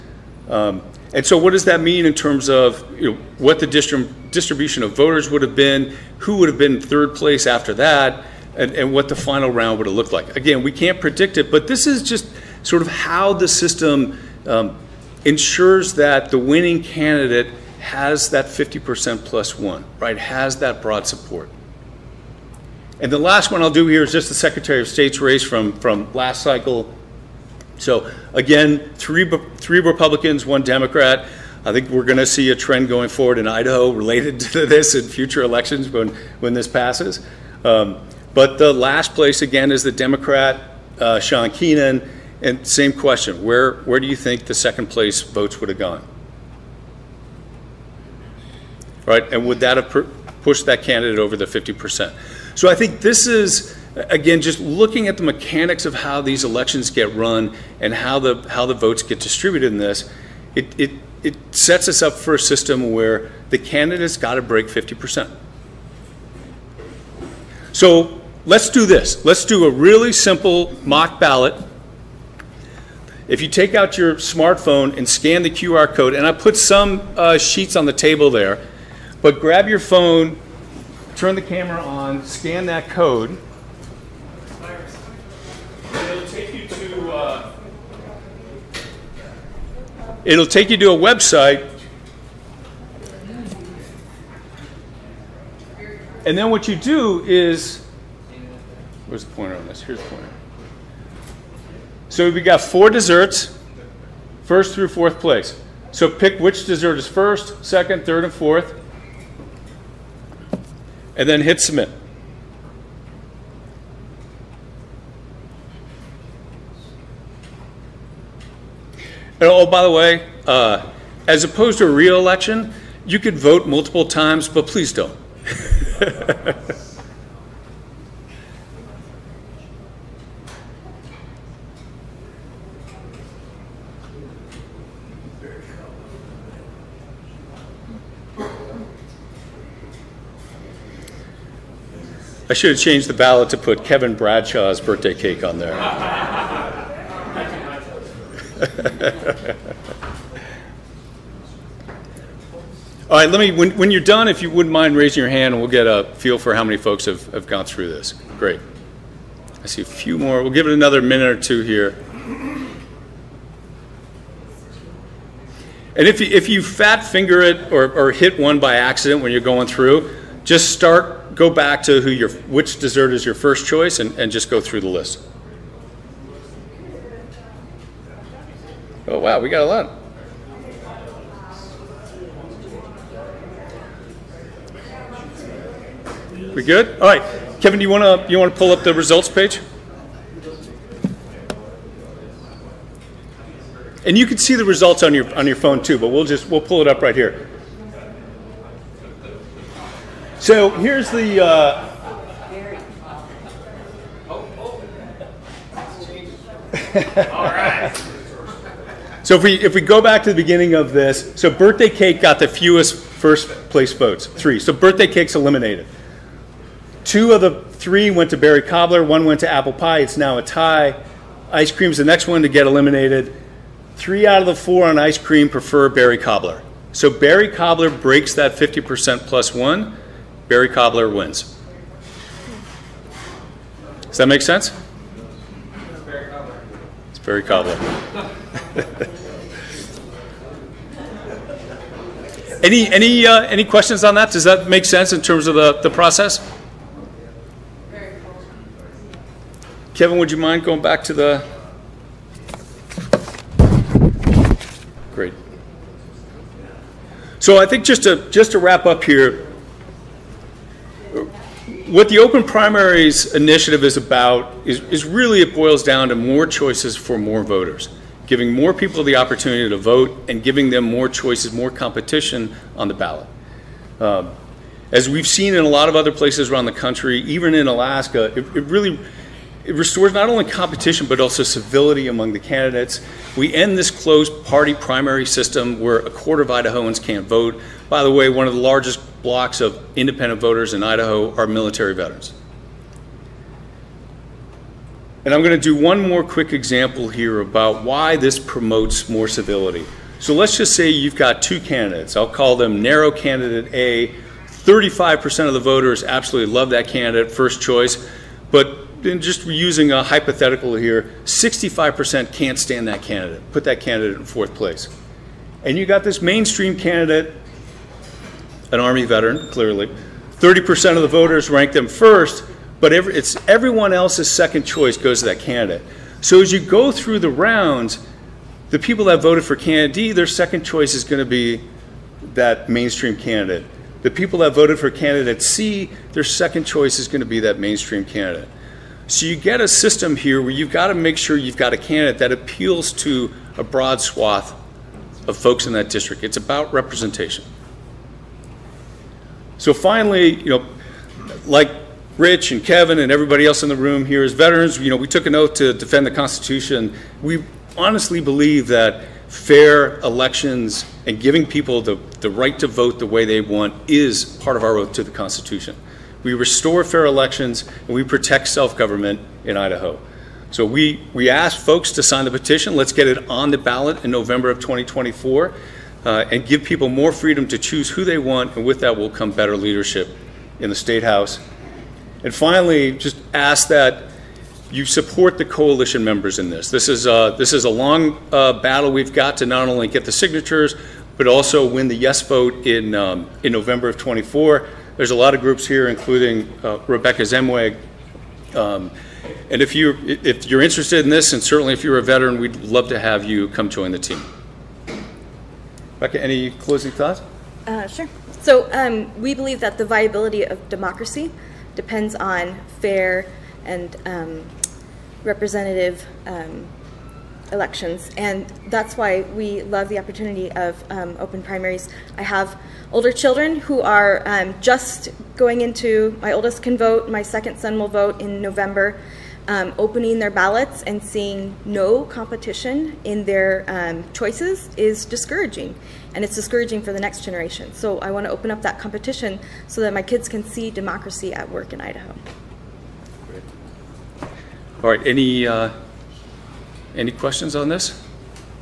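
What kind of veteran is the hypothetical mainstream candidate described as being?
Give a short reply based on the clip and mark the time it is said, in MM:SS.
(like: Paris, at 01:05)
Army veteran, at 05:18.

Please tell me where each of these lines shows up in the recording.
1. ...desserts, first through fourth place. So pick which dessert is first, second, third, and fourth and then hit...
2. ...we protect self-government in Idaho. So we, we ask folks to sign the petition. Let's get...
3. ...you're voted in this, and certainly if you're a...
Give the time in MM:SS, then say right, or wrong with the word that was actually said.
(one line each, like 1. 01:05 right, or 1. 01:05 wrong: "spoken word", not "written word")
1. 01:42 right
2. 06:07 right
3. 06:40 wrong: "interested", not "voted".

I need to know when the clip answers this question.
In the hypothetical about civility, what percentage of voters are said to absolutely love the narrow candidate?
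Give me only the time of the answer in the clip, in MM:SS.
05:04.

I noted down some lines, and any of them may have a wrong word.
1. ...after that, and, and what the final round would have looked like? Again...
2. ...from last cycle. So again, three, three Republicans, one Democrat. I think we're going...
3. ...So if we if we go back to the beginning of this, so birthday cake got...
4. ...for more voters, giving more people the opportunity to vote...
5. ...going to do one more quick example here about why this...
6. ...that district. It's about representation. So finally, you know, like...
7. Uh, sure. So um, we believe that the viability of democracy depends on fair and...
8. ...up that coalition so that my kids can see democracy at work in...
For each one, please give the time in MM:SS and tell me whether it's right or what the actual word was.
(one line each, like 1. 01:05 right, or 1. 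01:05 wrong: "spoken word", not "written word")
1. 00:07 right
2. 00:25 right
3. 03:29 right
4. 04:26 right
5. 04:55 right
6. 05:45 right
7. 06:47 right
8. 07:18 wrong: "competition", not "coalition".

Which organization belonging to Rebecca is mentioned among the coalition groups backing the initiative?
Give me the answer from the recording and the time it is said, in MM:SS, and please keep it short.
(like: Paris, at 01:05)
MWEG, at 06:37.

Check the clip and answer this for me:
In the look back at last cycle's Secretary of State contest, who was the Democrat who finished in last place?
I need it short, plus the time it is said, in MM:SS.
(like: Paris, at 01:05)
Sean Keenan, at 00:41.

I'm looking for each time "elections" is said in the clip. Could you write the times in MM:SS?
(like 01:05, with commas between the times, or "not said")
00:35, 00:56, 02:02, 06:00, 06:07, 06:57.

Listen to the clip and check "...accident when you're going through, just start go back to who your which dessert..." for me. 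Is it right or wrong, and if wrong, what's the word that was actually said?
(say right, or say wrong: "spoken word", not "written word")
right.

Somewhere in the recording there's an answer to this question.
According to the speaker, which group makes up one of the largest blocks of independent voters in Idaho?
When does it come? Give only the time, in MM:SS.
04:51.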